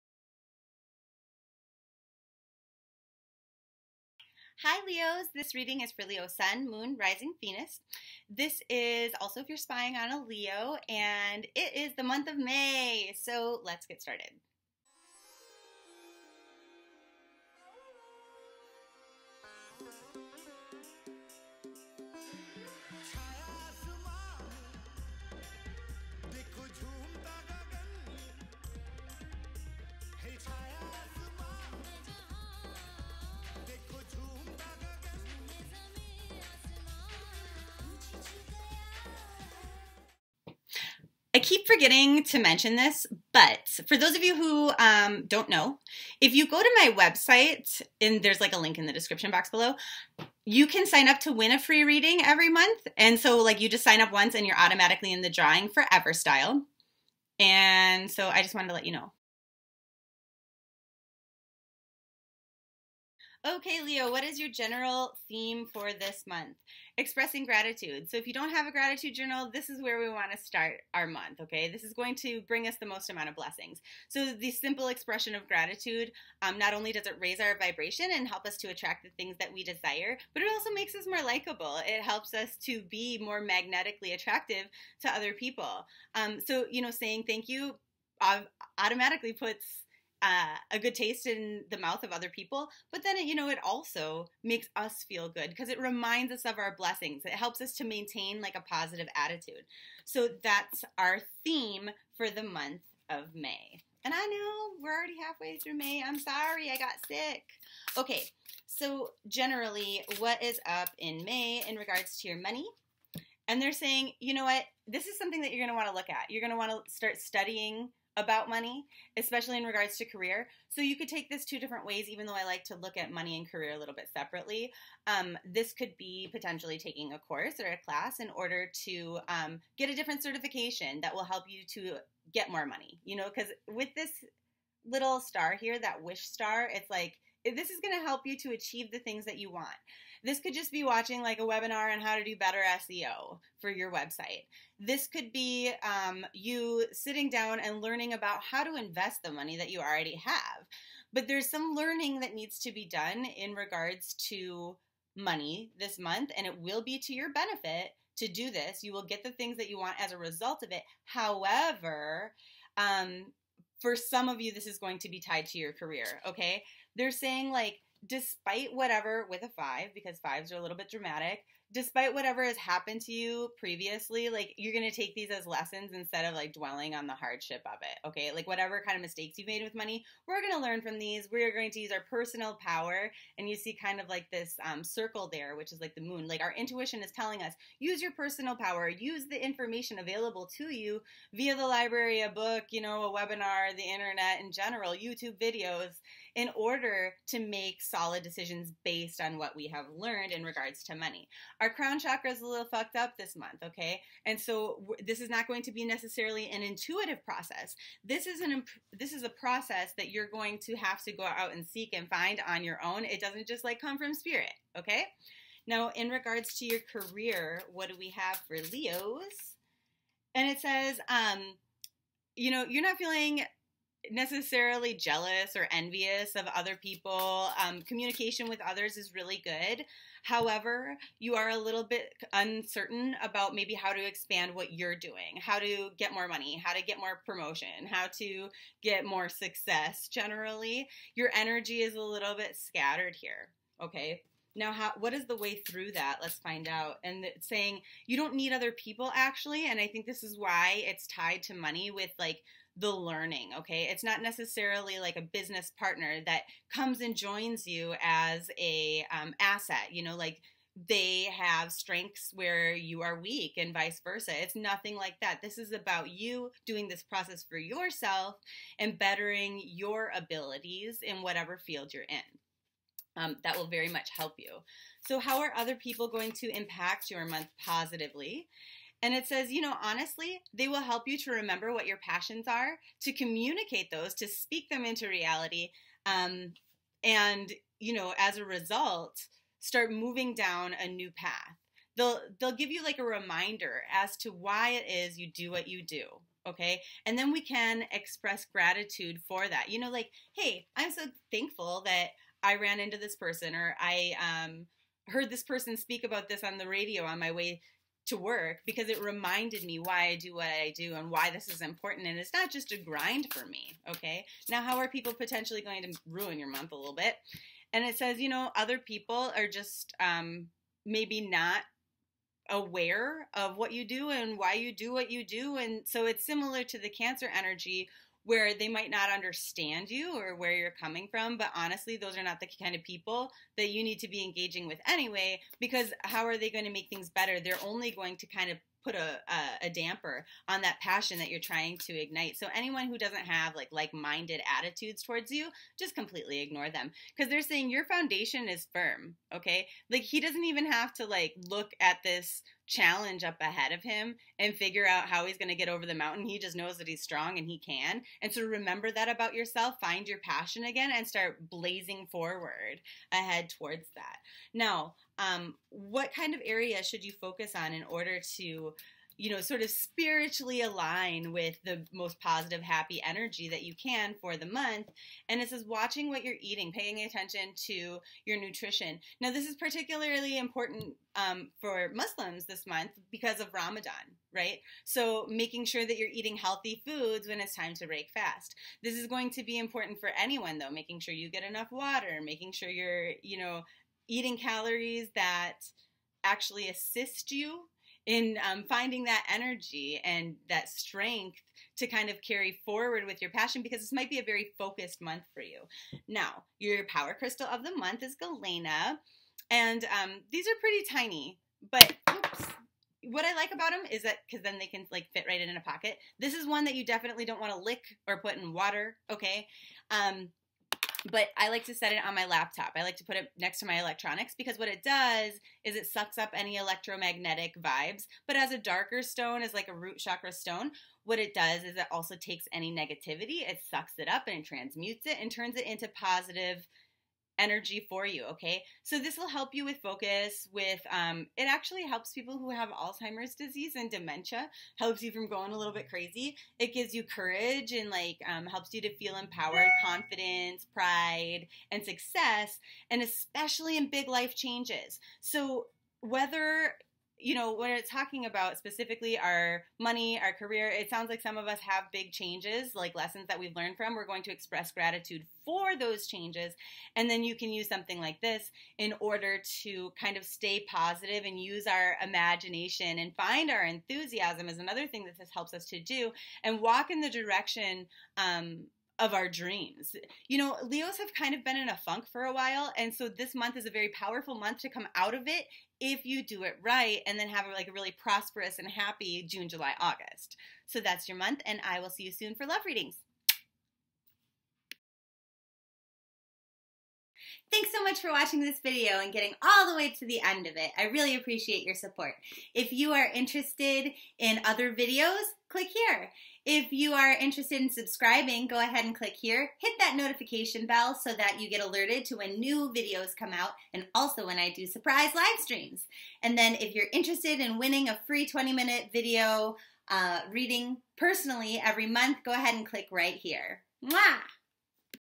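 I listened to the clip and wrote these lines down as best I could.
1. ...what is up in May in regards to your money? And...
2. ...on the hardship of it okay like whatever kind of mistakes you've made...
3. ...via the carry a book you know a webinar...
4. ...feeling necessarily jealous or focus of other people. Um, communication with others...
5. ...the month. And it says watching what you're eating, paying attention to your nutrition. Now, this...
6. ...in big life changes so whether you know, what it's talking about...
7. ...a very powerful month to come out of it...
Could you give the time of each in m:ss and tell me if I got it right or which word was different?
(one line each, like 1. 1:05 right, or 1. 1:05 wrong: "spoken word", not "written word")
1. 1:50 right
2. 2:56 right
3. 3:11 wrong: "library", not "carry"
4. 3:42 wrong: "envious", not "focus"
5. 6:14 right
6. 7:33 right
7. 8:03 right.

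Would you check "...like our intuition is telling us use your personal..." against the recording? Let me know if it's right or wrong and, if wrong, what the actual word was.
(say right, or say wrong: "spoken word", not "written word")
right.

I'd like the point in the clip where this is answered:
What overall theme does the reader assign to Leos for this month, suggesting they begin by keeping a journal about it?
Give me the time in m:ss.
1:06.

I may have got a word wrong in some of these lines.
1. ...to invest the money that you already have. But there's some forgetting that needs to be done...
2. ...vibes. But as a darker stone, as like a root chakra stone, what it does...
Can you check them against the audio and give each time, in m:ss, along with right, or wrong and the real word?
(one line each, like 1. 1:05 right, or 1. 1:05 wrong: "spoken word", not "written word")
1. 2:28 wrong: "learning", not "forgetting"
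2. 7:07 right.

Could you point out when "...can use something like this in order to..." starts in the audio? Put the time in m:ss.
7:47.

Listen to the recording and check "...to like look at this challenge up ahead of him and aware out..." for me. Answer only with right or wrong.
wrong.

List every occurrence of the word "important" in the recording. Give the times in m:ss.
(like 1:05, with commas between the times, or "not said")
5:11, 6:20, 6:29.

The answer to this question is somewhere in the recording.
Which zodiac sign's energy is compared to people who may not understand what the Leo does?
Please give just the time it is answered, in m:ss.
5:26.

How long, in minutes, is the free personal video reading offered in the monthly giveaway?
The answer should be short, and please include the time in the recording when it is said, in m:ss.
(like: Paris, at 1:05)
20, at 8:38.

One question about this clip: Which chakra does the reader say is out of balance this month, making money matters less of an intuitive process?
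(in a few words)
Crown chakra.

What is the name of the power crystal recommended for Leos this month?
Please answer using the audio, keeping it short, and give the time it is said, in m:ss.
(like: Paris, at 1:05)
Galena, at 6:48.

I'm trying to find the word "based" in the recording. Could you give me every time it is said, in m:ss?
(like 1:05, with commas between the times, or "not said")
3:18.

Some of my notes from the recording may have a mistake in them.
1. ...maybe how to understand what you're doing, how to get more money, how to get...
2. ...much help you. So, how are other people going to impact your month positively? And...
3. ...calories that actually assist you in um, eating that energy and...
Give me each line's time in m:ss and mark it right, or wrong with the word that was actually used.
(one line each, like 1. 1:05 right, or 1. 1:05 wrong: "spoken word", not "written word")
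1. 3:53 wrong: "expand", not "understand"
2. 4:33 right
3. 6:34 wrong: "finding", not "eating".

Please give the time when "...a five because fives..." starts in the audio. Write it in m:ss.
2:49.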